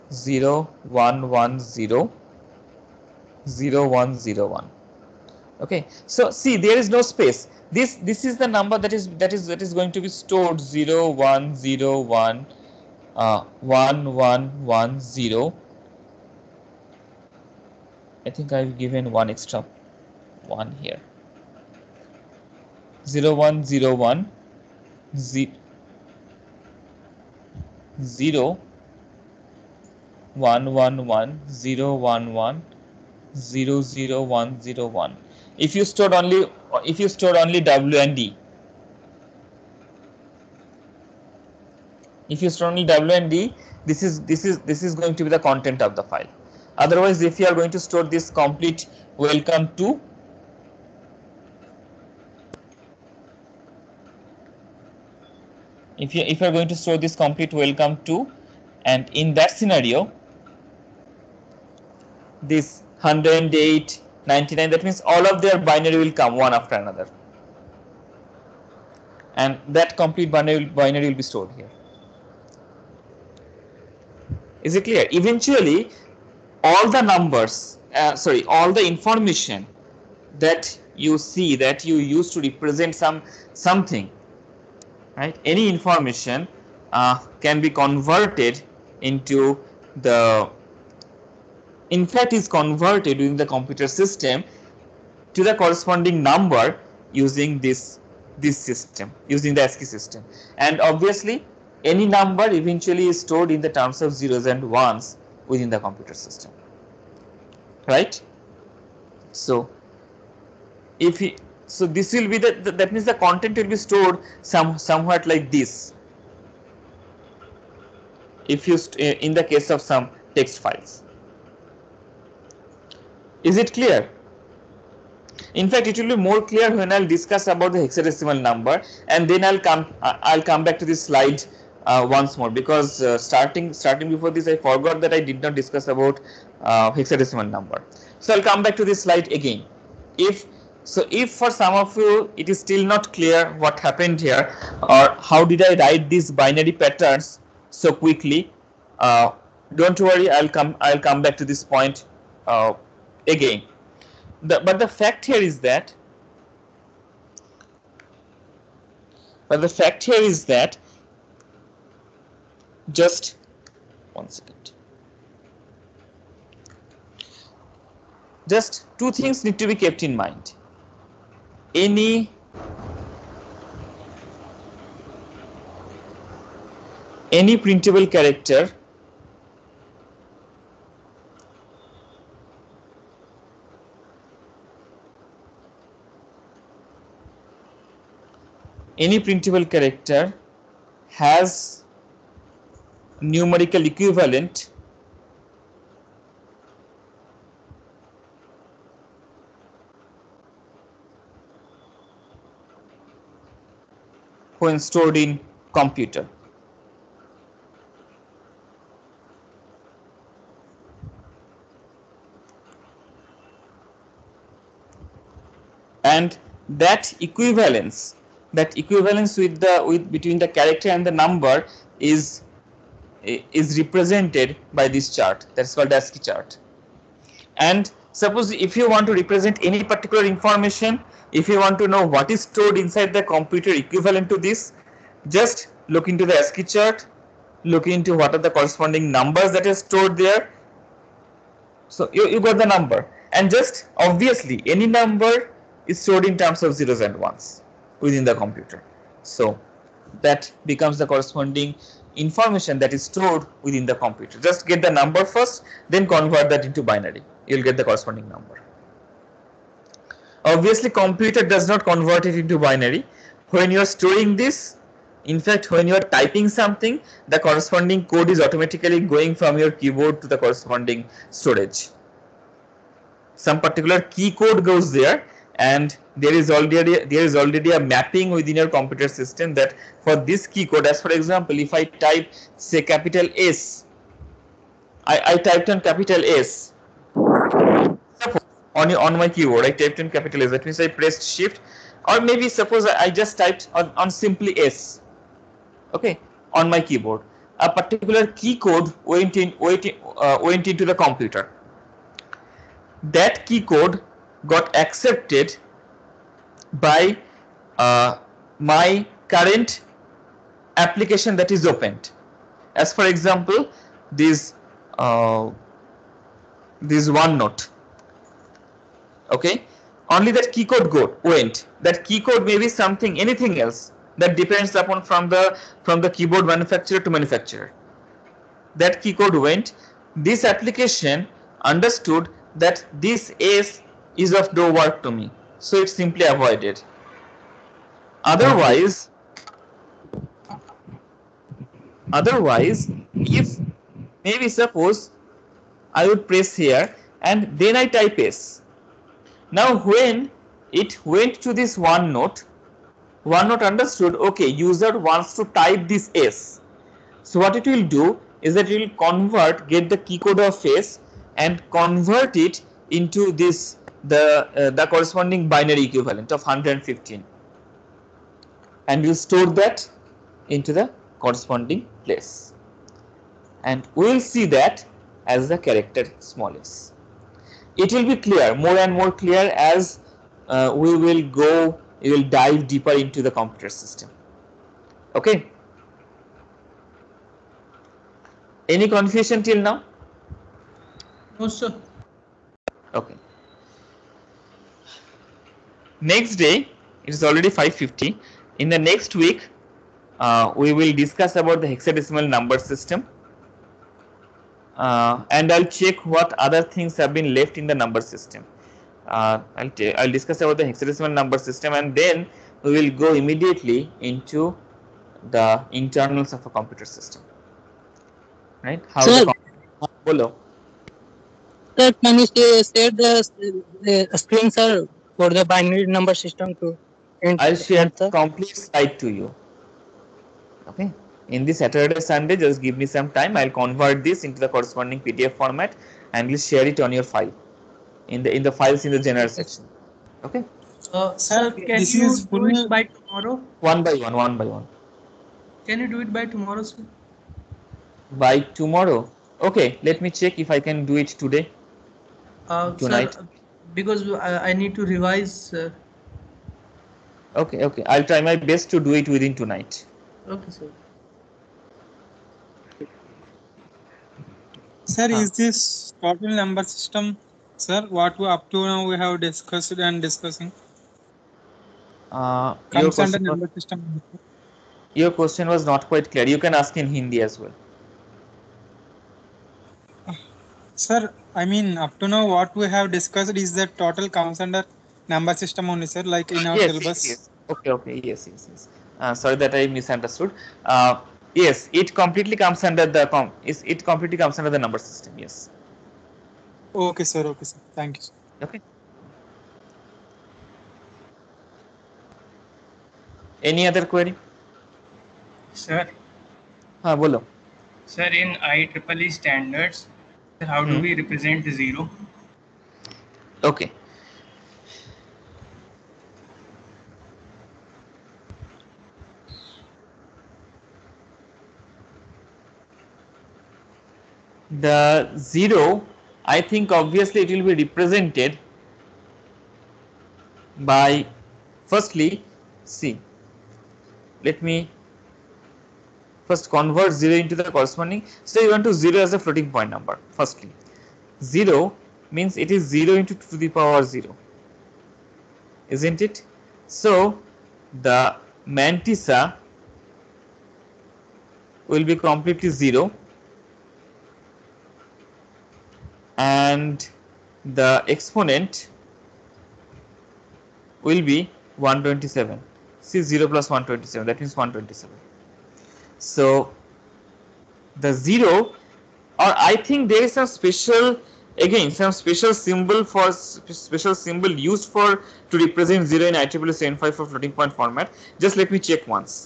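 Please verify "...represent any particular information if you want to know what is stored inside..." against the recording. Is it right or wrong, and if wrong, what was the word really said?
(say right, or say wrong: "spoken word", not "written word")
right.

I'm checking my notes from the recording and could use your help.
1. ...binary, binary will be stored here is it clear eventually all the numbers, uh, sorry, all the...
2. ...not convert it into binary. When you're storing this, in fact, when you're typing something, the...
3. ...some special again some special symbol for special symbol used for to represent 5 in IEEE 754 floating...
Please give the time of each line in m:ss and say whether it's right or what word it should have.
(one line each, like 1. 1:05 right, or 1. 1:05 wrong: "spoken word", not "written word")
1. 1:10 right
2. 4:21 right
3. 9:30 wrong: "0", not "5".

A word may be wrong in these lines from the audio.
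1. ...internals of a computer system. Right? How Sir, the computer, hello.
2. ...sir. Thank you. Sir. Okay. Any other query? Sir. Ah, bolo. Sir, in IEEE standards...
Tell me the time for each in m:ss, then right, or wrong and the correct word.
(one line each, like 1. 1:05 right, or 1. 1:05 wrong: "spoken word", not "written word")
1. 6:55 right
2. 8:17 right.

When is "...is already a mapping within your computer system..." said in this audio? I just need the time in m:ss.
4:37.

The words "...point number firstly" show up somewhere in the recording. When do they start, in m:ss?
8:59.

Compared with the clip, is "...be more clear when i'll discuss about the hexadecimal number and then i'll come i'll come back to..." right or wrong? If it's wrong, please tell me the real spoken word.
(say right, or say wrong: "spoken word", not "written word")
right.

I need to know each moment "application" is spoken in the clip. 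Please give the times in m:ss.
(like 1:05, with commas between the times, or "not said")
5:10, 5:30.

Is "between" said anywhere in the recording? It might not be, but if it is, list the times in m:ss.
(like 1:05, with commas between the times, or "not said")
3:40.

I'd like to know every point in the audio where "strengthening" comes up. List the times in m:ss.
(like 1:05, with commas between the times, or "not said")
not said.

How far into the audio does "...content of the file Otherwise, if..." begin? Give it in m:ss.
0:45.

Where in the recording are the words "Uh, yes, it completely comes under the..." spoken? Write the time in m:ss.
8:10.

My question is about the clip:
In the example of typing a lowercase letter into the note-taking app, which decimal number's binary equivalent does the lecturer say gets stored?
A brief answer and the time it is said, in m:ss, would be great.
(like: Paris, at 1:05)
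115, at 6:06.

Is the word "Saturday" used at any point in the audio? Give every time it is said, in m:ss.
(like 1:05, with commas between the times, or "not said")
7:11.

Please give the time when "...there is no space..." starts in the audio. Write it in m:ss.
0:06.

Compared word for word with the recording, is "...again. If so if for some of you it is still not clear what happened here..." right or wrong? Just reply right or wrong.
right.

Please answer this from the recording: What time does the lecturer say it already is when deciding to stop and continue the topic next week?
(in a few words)
5:50.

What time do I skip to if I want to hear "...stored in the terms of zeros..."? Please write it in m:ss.
1:43.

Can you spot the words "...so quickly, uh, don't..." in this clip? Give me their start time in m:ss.
2:27.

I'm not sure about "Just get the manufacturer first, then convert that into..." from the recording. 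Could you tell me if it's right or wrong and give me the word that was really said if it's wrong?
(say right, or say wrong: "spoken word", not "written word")
wrong: "number", not "manufacturer".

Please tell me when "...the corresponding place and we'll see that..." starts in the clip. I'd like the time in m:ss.
6:10.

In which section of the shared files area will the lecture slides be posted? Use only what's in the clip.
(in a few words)
general section.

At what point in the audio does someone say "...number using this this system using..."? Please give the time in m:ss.
1:36.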